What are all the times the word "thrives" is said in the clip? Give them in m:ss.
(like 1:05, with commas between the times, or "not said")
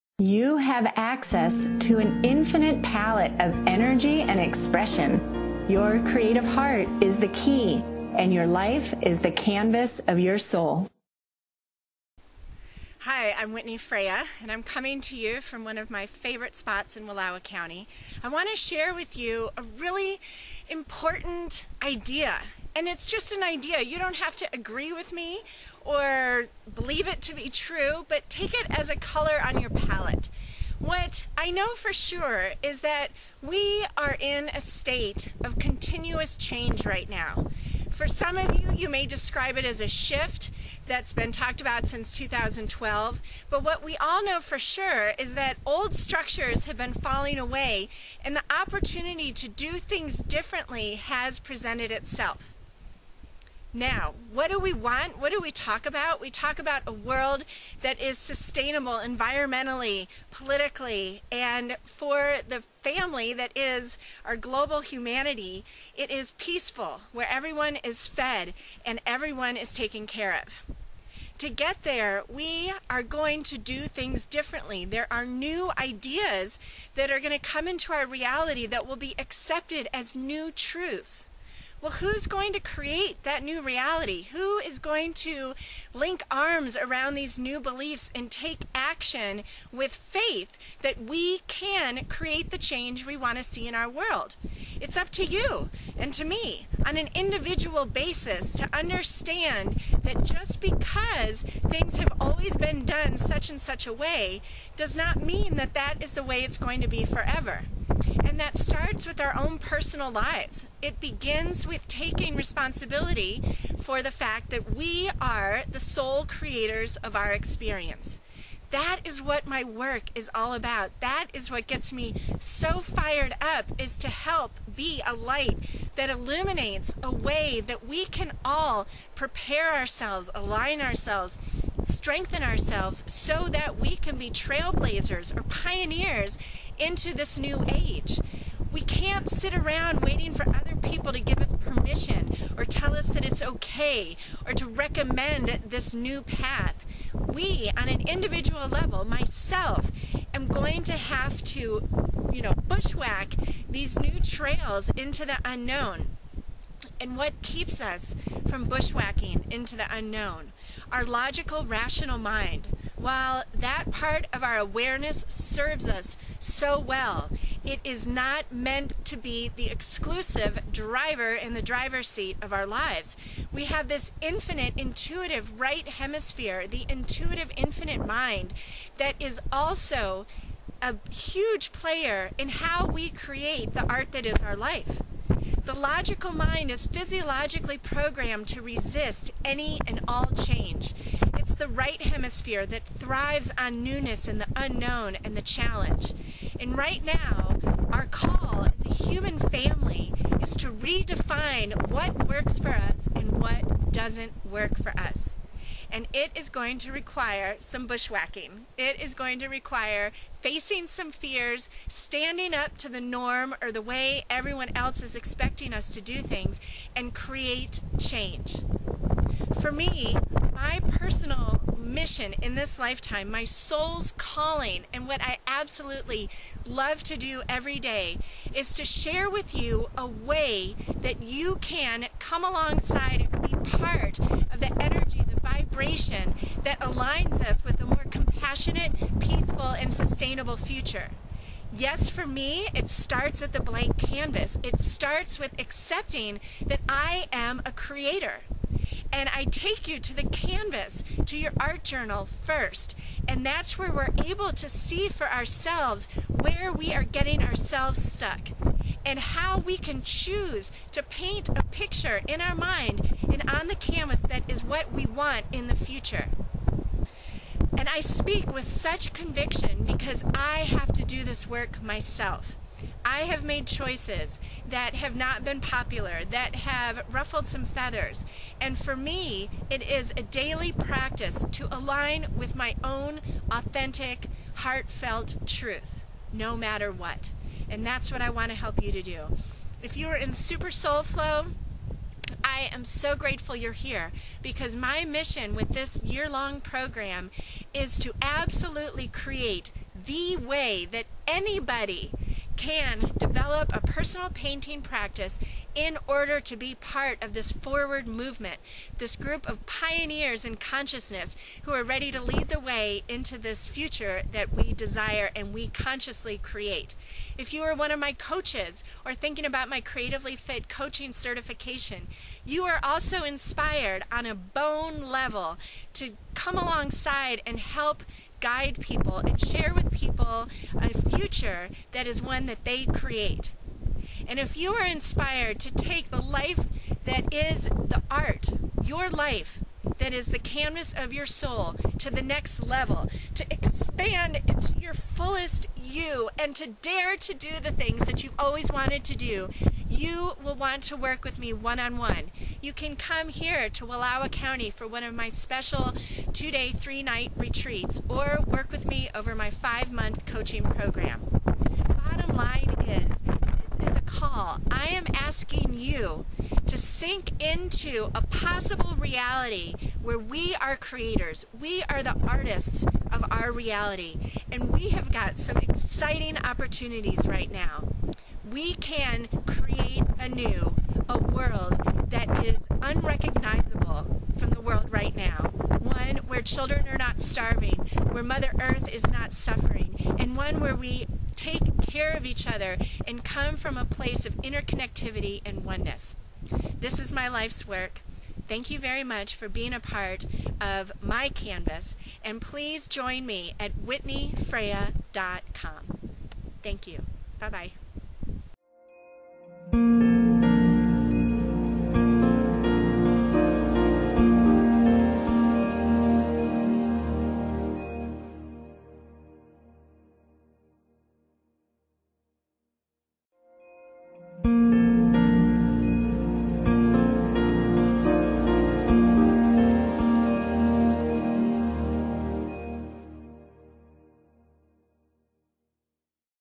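3:12.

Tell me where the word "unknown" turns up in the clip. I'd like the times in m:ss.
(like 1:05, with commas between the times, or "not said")
2:35, 2:39, 3:14.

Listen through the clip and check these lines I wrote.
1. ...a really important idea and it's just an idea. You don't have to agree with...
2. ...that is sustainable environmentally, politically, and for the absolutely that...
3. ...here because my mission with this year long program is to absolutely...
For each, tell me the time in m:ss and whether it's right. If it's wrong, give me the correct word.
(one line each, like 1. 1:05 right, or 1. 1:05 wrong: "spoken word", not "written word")
1. 0:19 right
2. 0:57 wrong: "family", not "absolutely"
3. 4:53 right.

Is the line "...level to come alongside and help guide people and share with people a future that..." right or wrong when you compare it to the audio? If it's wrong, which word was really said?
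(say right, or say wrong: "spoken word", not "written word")
right.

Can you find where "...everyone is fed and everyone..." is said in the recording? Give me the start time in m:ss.
1:07.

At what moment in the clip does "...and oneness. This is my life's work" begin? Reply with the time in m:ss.
6:35.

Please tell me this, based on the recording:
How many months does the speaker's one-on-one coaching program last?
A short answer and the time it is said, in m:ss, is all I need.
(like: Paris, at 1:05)
5, at 5:59.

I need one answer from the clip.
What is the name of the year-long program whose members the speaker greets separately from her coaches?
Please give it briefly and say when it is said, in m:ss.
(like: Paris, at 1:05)
Super Soul Flow, at 4:50.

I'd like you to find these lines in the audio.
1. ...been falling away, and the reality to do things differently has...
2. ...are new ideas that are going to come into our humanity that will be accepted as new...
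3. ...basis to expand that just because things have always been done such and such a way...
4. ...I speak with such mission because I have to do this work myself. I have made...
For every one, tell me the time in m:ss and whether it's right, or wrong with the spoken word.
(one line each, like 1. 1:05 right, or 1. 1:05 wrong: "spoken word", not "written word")
1. 0:46 wrong: "opportunity", not "reality"
2. 1:15 wrong: "reality", not "humanity"
3. 1:37 wrong: "understand", not "expand"
4. 4:27 wrong: "conviction", not "mission".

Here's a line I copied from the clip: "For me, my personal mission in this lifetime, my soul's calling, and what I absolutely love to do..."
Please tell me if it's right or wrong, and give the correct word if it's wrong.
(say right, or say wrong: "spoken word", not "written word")
right.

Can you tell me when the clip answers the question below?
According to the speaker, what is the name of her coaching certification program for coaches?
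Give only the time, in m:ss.
5:19.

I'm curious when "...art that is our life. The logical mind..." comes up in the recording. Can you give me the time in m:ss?
3:03.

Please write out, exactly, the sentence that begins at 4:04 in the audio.
It starts with accepting that I am a creator and I take you to the canvas, to your art journal first.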